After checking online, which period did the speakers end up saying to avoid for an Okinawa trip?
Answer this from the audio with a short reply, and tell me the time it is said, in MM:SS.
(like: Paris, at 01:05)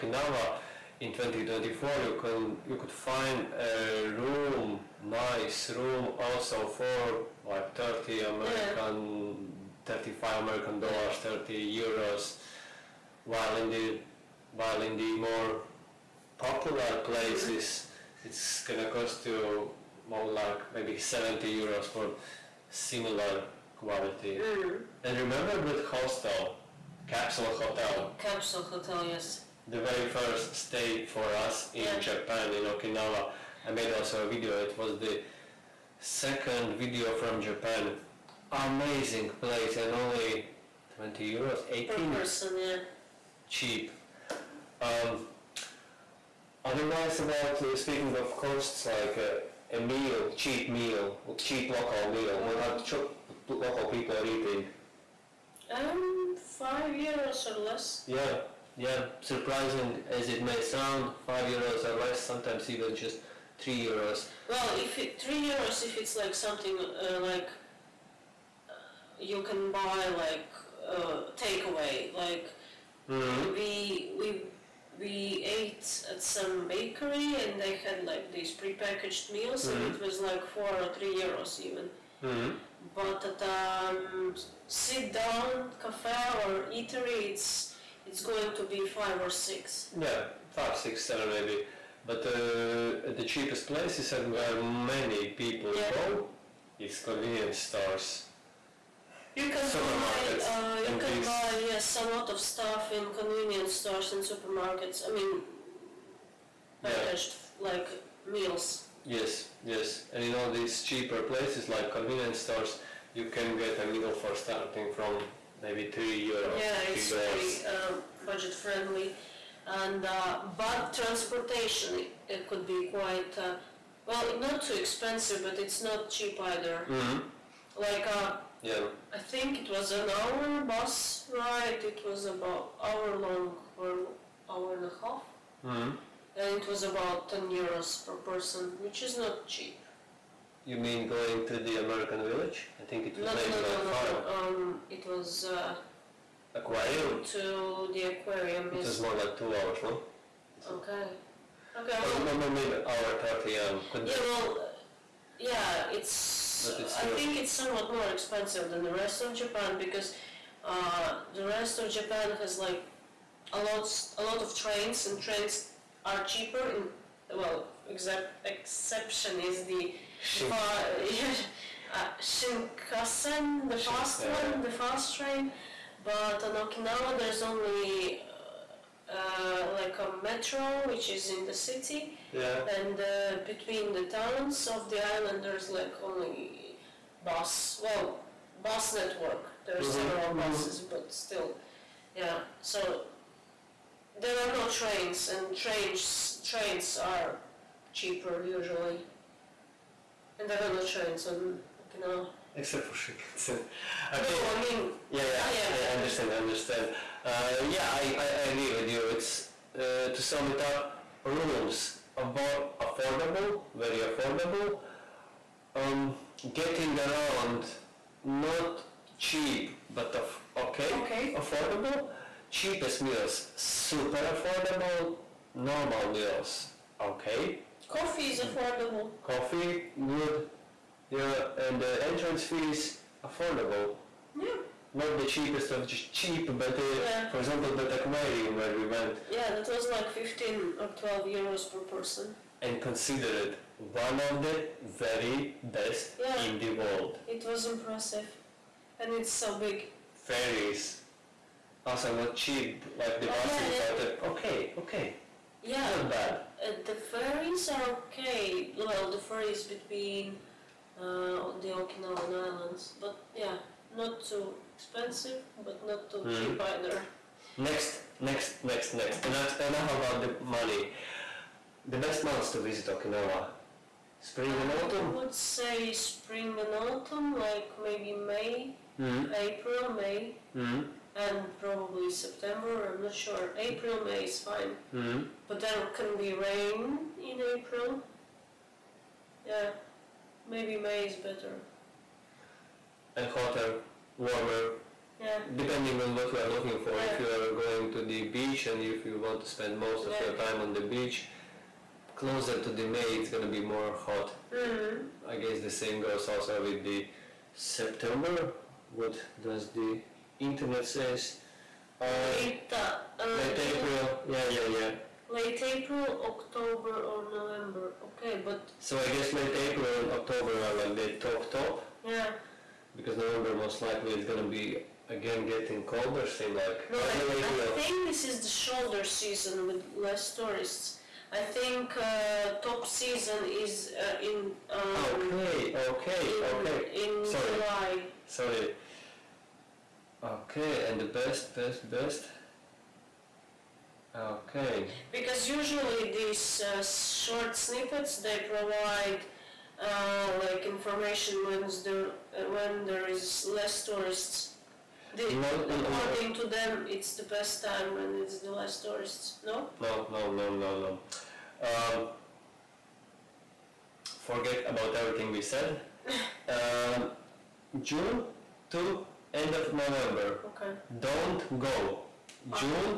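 June to end of November, at 06:07.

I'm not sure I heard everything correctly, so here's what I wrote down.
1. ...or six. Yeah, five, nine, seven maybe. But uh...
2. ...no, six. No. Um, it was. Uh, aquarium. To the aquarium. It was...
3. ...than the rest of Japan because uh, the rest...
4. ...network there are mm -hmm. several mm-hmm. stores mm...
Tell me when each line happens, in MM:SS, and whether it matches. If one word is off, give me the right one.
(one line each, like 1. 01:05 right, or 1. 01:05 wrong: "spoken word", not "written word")
1. 01:29 wrong: "six", not "nine"
2. 02:23 wrong: "five", not "six"
3. 02:38 right
4. 03:08 wrong: "buses", not "stores".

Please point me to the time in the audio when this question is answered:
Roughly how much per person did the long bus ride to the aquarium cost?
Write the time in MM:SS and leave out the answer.
02:17.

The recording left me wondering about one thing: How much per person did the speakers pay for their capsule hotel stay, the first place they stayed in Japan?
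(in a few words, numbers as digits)
18 euros.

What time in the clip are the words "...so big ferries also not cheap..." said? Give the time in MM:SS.
04:09.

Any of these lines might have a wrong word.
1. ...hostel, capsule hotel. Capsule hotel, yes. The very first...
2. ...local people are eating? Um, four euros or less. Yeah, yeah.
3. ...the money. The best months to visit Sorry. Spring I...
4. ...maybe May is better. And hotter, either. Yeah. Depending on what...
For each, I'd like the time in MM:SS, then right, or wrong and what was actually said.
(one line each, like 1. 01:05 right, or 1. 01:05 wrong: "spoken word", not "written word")
1. 00:25 right
2. 00:53 wrong: "five", not "four"
3. 04:30 wrong: "Okinawa", not "Sorry"
4. 04:50 wrong: "warmer", not "either".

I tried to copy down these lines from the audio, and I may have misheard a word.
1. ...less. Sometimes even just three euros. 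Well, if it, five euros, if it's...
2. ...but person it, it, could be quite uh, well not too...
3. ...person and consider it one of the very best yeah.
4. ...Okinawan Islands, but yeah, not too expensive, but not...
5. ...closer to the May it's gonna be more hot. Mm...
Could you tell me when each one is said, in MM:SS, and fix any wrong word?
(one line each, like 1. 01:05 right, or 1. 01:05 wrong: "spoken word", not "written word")
1. 01:01 wrong: "three", not "five"
2. 02:00 wrong: "transportation", not "person"
3. 04:01 right
4. 04:21 right
5. 05:02 right.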